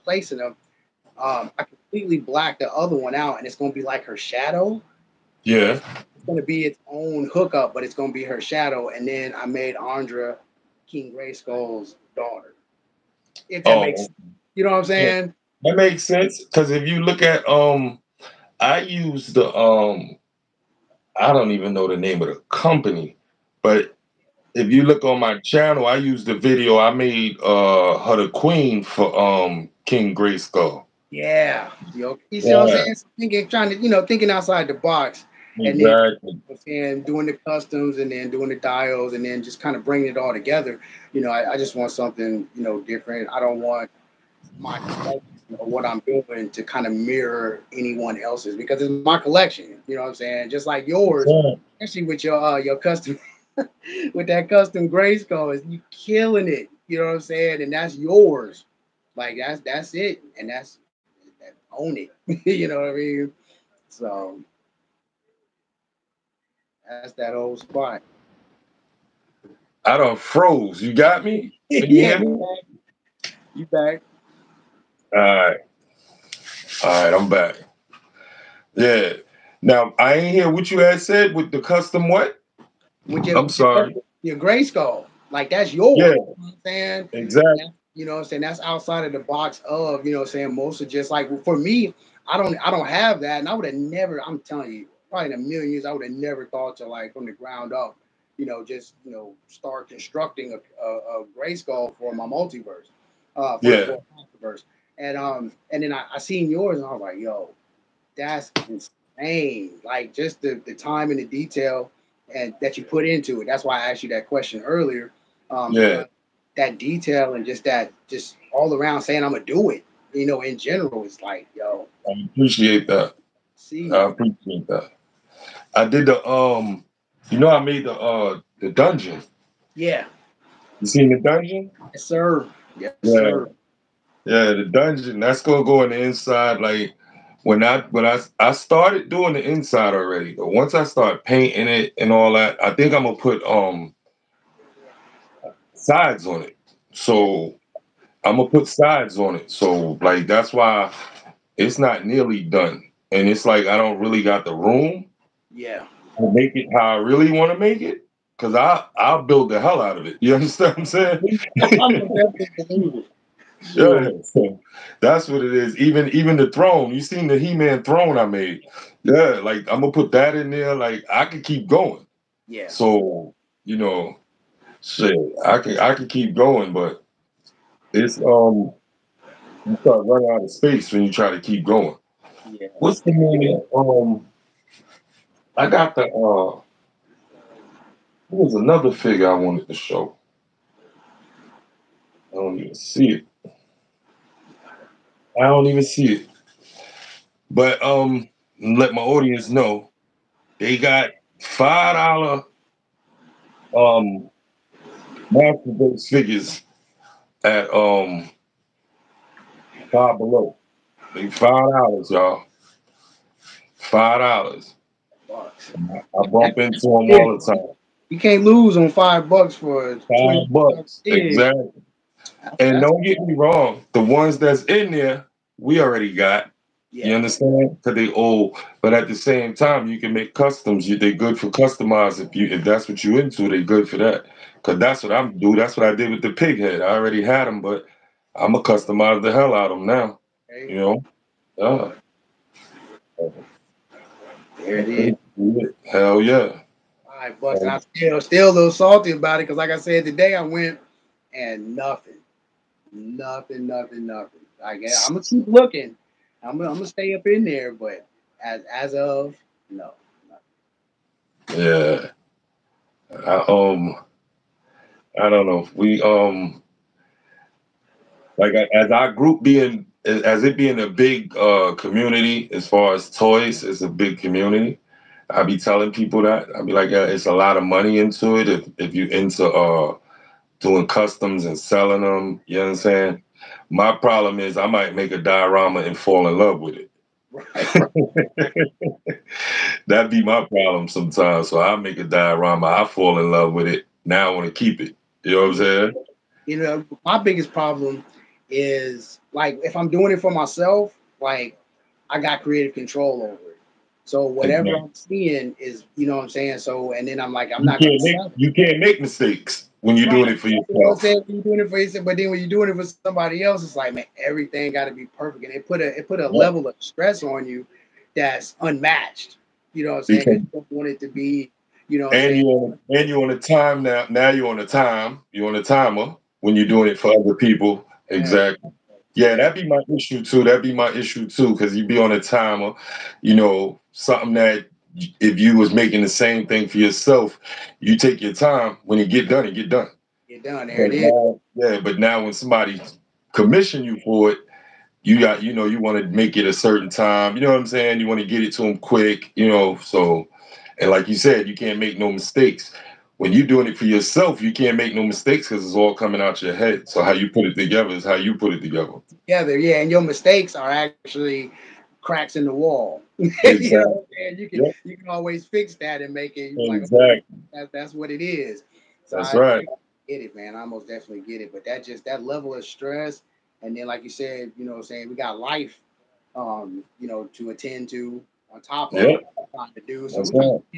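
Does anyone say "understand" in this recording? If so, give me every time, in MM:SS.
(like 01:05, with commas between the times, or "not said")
02:40, 03:47.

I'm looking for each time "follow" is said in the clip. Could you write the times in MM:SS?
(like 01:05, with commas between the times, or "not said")
not said.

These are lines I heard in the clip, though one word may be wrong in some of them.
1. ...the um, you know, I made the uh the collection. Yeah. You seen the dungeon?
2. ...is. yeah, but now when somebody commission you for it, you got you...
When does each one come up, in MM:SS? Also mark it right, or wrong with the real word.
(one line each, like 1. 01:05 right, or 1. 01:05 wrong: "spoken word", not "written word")
1. 02:06 wrong: "dungeon", not "collection"
2. 05:41 right.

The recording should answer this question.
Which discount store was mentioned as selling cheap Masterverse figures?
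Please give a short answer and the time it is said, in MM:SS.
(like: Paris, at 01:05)
Five Below, at 03:29.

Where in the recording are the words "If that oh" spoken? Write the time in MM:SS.
00:13.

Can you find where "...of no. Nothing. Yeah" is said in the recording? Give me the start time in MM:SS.
04:18.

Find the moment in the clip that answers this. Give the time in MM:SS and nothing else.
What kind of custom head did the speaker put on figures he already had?
03:56.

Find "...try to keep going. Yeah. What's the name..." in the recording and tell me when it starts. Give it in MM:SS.
03:01.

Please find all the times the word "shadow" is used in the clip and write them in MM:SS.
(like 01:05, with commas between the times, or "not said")
00:04, 00:08.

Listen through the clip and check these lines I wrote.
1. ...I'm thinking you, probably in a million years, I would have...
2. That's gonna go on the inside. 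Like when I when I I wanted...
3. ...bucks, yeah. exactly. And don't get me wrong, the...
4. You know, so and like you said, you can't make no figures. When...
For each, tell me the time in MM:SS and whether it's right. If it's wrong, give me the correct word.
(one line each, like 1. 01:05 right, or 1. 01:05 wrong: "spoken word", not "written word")
1. 01:34 wrong: "telling", not "thinking"
2. 02:15 wrong: "started", not "wanted"
3. 03:40 right
4. 05:49 wrong: "mistakes", not "figures".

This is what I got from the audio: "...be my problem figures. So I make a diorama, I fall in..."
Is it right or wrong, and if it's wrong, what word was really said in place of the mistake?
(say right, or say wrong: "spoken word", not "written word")
wrong: "sometimes", not "figures".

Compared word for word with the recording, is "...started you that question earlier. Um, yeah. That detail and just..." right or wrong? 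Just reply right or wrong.
wrong.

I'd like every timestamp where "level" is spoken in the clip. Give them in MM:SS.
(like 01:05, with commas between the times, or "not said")
05:16, 06:12.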